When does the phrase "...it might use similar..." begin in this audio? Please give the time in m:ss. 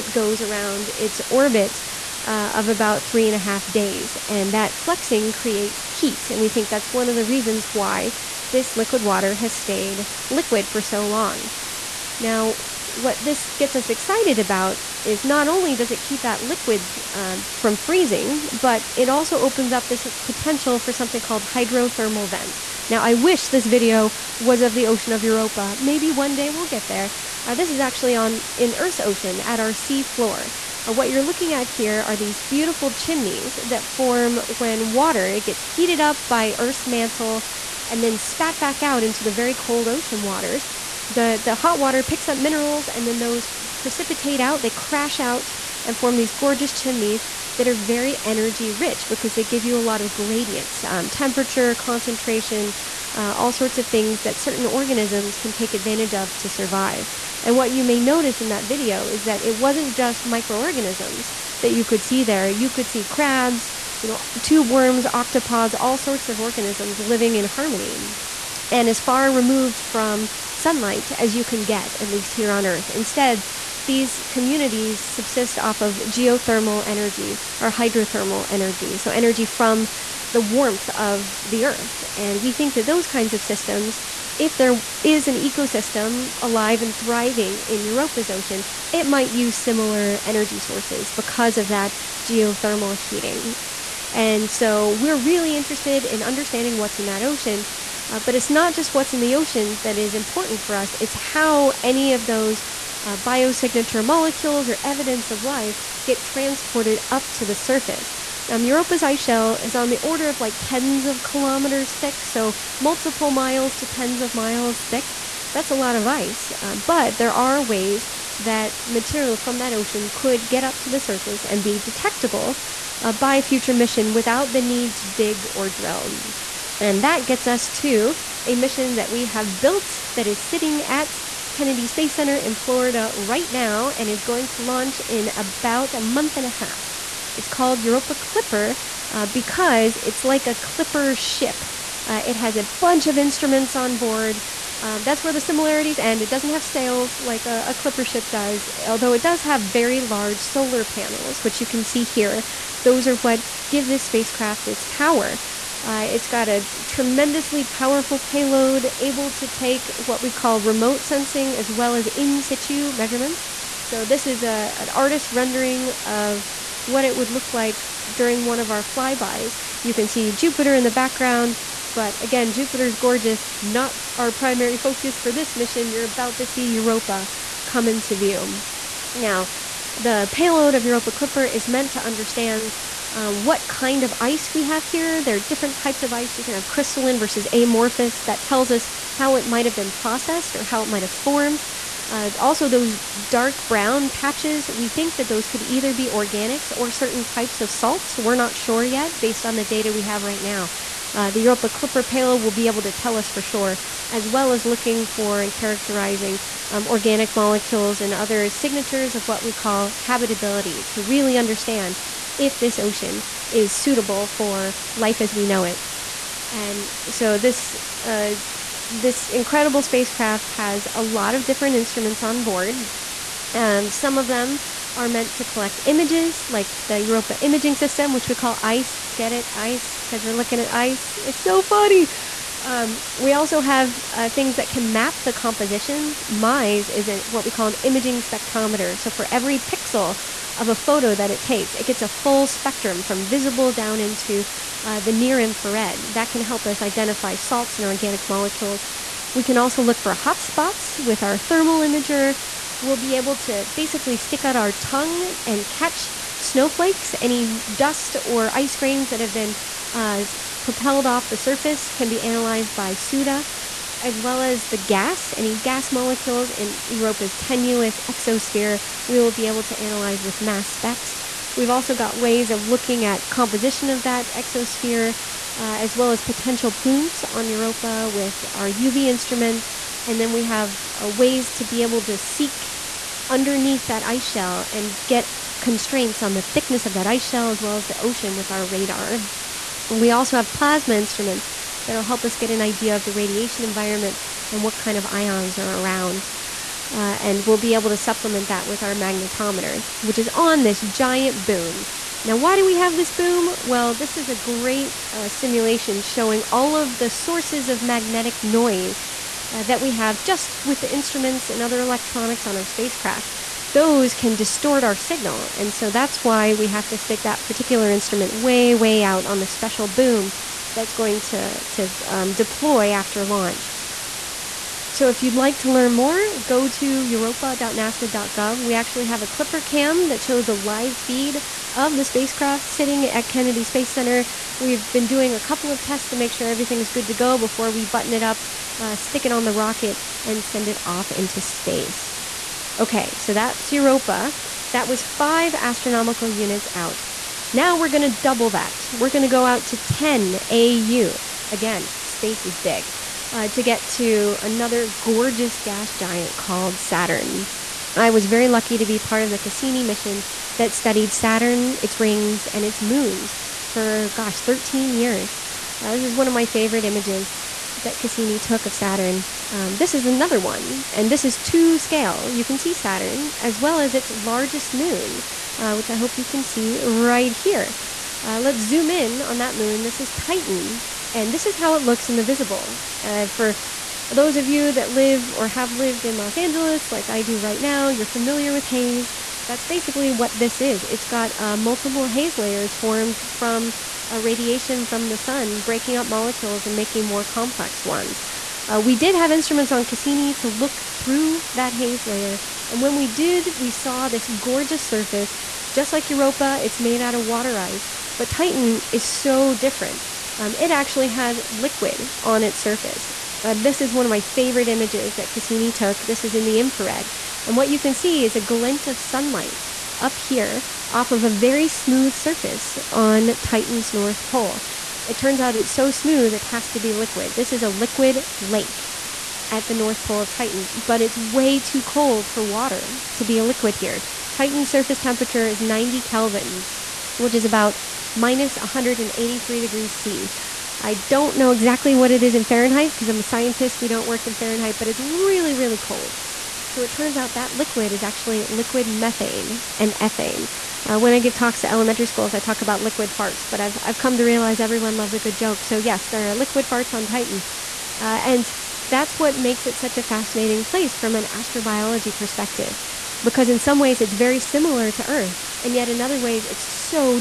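1:28.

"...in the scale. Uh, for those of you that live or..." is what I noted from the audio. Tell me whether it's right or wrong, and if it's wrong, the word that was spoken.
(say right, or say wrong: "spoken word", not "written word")
wrong: "visible", not "scale".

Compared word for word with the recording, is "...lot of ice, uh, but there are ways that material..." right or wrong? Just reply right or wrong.
right.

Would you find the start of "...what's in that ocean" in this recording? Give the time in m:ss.
1:36.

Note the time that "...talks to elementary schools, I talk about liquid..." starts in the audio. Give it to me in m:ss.
7:31.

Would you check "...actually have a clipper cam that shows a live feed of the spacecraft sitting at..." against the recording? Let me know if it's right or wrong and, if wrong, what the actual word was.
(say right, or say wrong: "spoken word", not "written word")
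right.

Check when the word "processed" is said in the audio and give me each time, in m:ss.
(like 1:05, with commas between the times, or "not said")
3:09.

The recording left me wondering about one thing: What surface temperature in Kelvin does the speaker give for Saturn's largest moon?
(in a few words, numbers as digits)
90 Kelvin.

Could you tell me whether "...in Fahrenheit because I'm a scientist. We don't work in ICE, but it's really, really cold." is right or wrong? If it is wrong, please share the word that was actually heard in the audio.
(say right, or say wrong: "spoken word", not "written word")
wrong: "Fahrenheit", not "ICE".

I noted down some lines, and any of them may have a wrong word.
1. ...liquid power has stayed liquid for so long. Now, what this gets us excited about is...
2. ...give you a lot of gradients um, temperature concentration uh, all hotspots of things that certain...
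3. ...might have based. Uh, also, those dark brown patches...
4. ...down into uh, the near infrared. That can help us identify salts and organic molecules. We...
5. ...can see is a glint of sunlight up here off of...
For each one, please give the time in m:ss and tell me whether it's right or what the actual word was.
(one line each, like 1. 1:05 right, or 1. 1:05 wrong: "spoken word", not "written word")
1. 0:08 wrong: "water", not "power"
2. 0:49 wrong: "sorts", not "hotspots"
3. 3:10 wrong: "formed", not "based"
4. 4:03 right
5. 6:57 right.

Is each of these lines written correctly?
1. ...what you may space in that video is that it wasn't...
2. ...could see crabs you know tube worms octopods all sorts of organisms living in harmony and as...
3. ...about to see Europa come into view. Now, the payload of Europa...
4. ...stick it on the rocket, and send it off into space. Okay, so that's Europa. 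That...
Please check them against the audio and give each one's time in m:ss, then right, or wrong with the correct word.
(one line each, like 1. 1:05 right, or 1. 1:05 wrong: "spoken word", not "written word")
1. 0:57 wrong: "notice", not "space"
2. 1:02 right
3. 2:56 right
4. 5:38 right.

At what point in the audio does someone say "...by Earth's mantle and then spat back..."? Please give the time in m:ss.
0:36.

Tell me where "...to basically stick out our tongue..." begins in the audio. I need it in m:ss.
4:13.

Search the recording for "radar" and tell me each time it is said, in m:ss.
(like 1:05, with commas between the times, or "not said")
4:48.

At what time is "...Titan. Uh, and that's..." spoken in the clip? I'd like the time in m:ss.
7:37.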